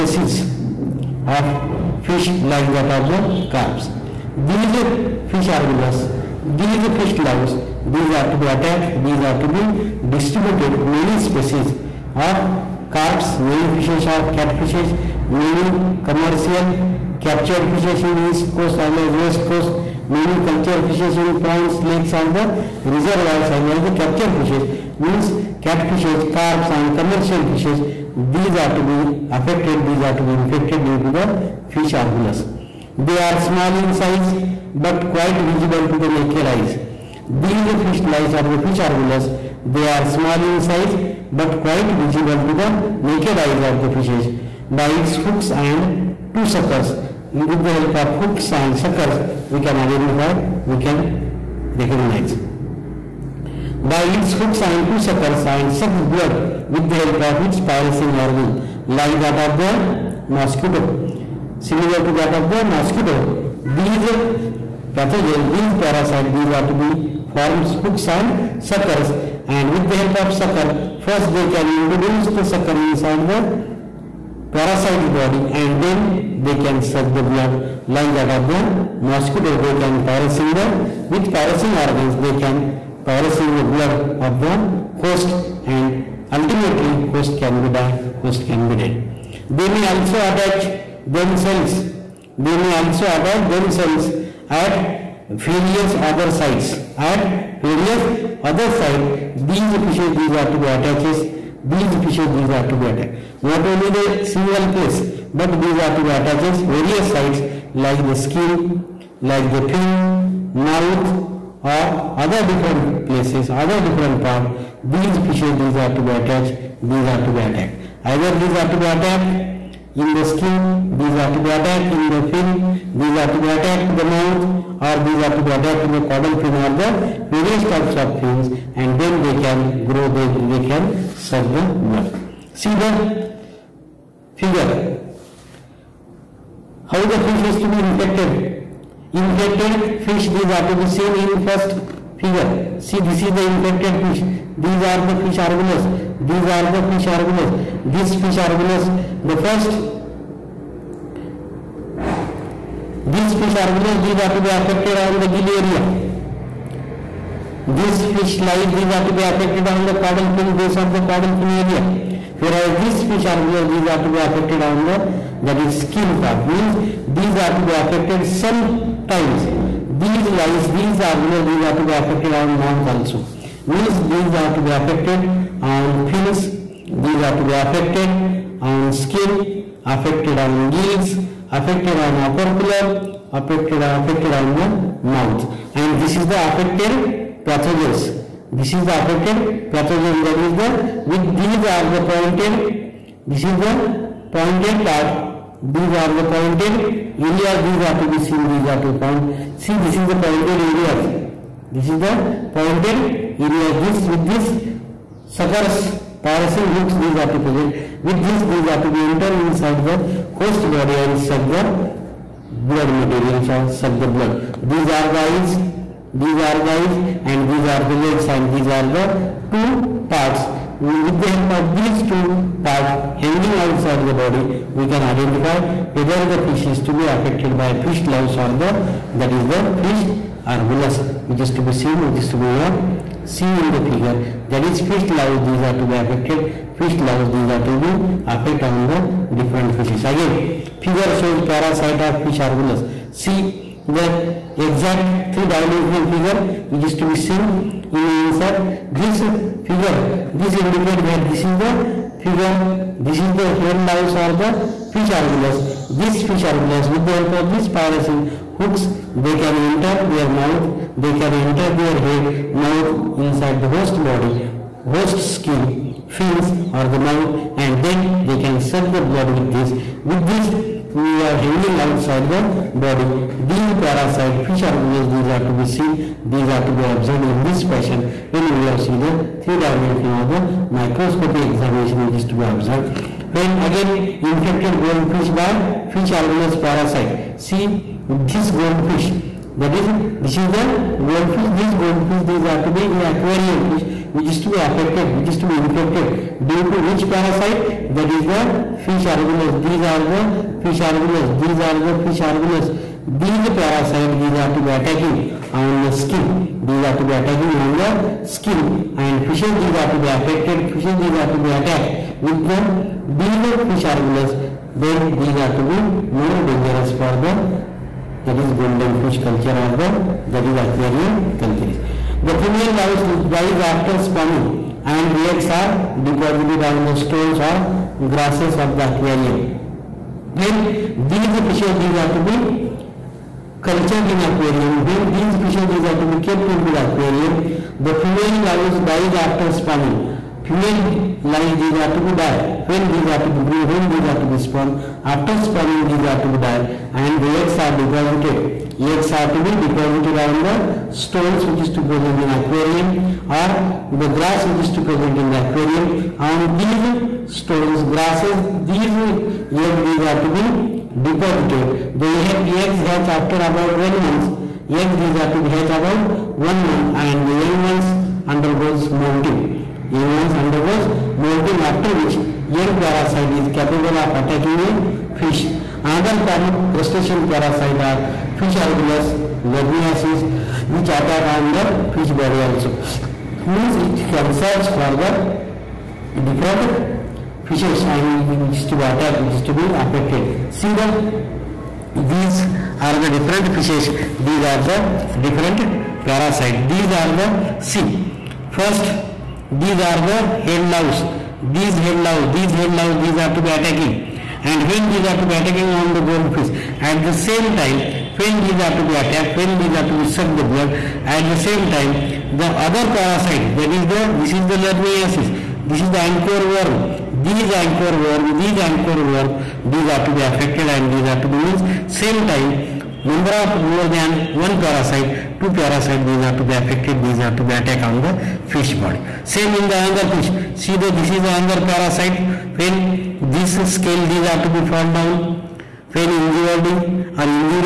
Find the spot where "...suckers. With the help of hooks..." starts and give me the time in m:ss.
0:46.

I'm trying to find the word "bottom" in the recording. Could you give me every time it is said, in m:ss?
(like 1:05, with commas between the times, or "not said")
not said.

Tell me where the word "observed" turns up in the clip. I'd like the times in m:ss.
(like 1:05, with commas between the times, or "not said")
4:36, 4:42.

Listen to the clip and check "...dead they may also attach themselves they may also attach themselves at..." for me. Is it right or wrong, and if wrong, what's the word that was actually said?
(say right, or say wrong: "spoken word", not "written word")
right.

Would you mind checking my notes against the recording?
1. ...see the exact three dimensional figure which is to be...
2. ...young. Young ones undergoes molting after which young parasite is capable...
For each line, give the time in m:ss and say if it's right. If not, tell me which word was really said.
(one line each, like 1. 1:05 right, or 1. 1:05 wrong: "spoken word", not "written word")
1. 4:03 right
2. 6:08 wrong: "molting", not "young".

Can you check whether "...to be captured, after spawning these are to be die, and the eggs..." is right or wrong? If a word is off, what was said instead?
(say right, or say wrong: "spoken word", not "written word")
wrong: "spawned", not "captured".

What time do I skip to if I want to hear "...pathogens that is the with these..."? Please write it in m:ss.
3:09.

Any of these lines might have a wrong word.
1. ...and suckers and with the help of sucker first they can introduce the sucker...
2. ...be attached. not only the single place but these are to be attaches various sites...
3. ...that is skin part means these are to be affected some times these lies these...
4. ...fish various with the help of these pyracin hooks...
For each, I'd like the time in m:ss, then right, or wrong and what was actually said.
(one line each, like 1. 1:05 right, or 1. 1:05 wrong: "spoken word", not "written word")
1. 1:08 right
2. 1:42 right
3. 2:45 right
4. 4:16 wrong: "argulus", not "various".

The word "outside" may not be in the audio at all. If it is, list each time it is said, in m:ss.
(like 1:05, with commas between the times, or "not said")
3:43, 4:31.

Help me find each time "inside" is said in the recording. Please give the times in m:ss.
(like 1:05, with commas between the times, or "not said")
1:12, 3:29, 4:23.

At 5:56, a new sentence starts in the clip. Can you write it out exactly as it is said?
On these stones, grasses, these egg these are to be deposited.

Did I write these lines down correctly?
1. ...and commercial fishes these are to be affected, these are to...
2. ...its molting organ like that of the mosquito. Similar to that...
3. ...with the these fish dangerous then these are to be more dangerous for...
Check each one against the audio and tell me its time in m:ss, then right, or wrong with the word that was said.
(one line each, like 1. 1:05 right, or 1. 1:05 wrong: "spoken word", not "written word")
1. 0:26 right
2. 0:57 wrong: "piercing", not "molting"
3. 5:12 wrong: "argulus", not "dangerous".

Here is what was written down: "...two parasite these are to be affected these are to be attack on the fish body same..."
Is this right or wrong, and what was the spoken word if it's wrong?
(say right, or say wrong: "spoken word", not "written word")
right.